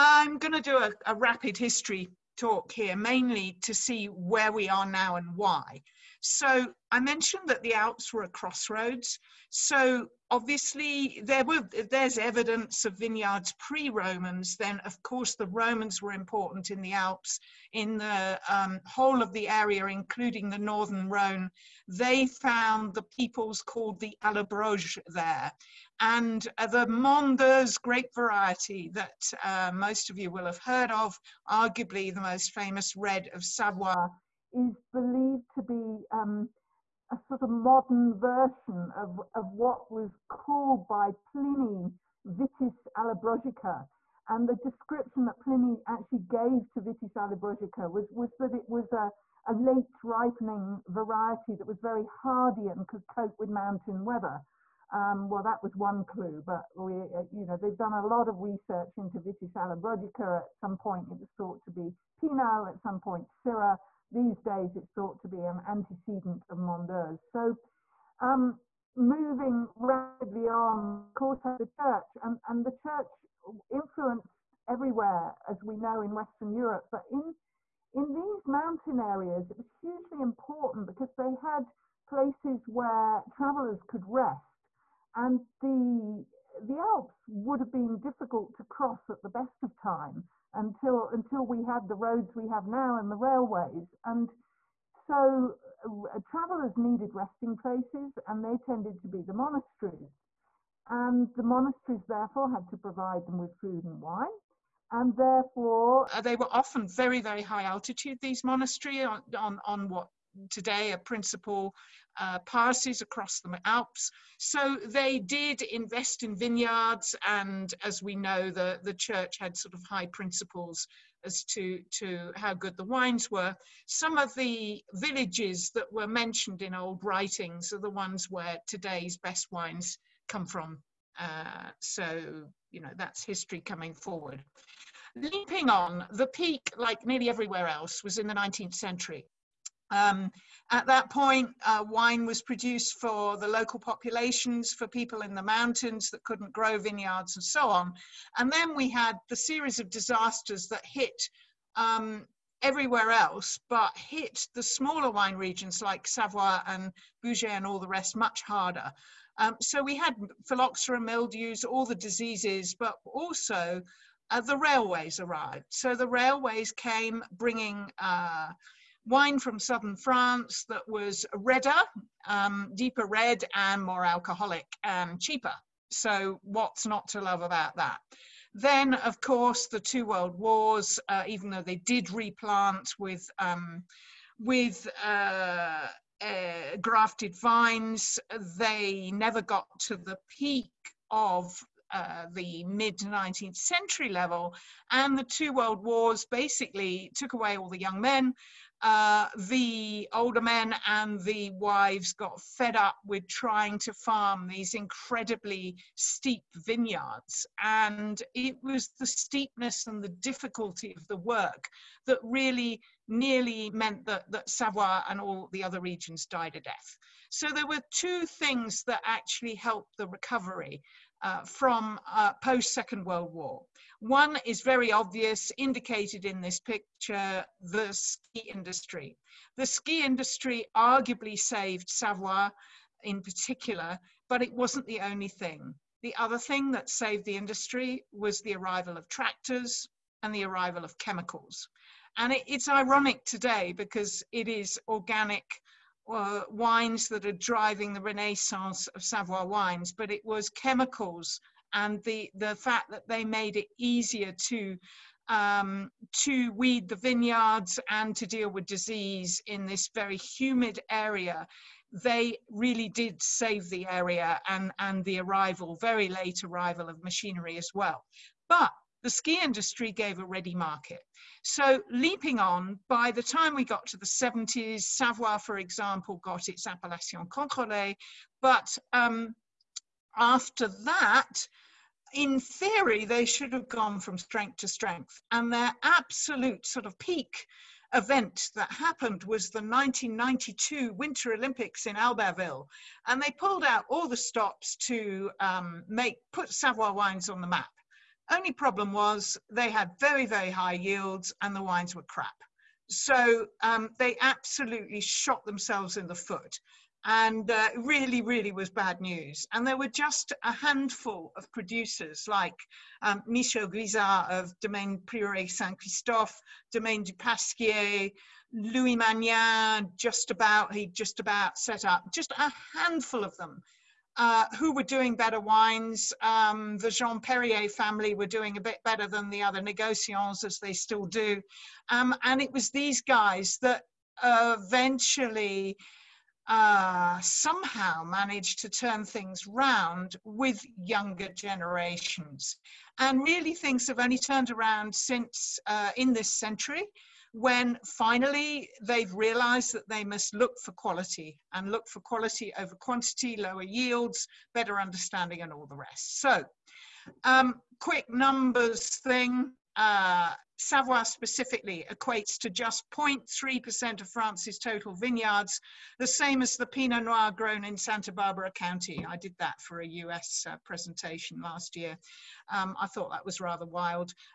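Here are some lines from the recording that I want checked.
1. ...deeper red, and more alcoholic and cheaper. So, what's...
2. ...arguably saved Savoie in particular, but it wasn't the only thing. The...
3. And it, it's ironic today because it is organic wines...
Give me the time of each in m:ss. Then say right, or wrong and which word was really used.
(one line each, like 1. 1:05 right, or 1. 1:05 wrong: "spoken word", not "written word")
1. 2:52 right
2. 3:50 right
3. 4:02 right.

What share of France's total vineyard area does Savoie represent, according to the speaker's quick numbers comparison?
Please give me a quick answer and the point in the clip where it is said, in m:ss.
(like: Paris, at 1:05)
0.3%, at 6:02.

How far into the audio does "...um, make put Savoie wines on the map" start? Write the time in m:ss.
4:55.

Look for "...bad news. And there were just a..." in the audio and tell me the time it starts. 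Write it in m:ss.
5:08.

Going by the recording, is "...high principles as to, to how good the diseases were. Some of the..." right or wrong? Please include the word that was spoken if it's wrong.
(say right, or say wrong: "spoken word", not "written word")
wrong: "wines", not "diseases".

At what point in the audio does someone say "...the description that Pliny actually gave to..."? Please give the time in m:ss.
0:44.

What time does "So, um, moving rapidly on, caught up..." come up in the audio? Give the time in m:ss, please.
1:07.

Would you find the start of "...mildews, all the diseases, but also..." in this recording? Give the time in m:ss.
2:41.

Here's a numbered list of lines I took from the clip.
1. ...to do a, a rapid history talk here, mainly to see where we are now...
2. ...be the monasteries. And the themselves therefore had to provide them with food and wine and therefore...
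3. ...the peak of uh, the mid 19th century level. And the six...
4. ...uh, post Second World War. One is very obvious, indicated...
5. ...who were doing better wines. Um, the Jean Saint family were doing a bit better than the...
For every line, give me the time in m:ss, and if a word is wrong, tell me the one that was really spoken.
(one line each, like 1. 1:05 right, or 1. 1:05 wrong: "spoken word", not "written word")
1. 0:00 right
2. 1:39 wrong: "monasteries", not "themselves"
3. 3:09 wrong: "two", not "six"
4. 3:42 right
5. 5:24 wrong: "Perrier", not "Saint".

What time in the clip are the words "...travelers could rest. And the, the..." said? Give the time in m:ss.
1:23.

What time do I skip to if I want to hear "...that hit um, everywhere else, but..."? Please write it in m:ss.
2:30.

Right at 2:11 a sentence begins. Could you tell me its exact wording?
Uh, so, you know, that's history coming forward.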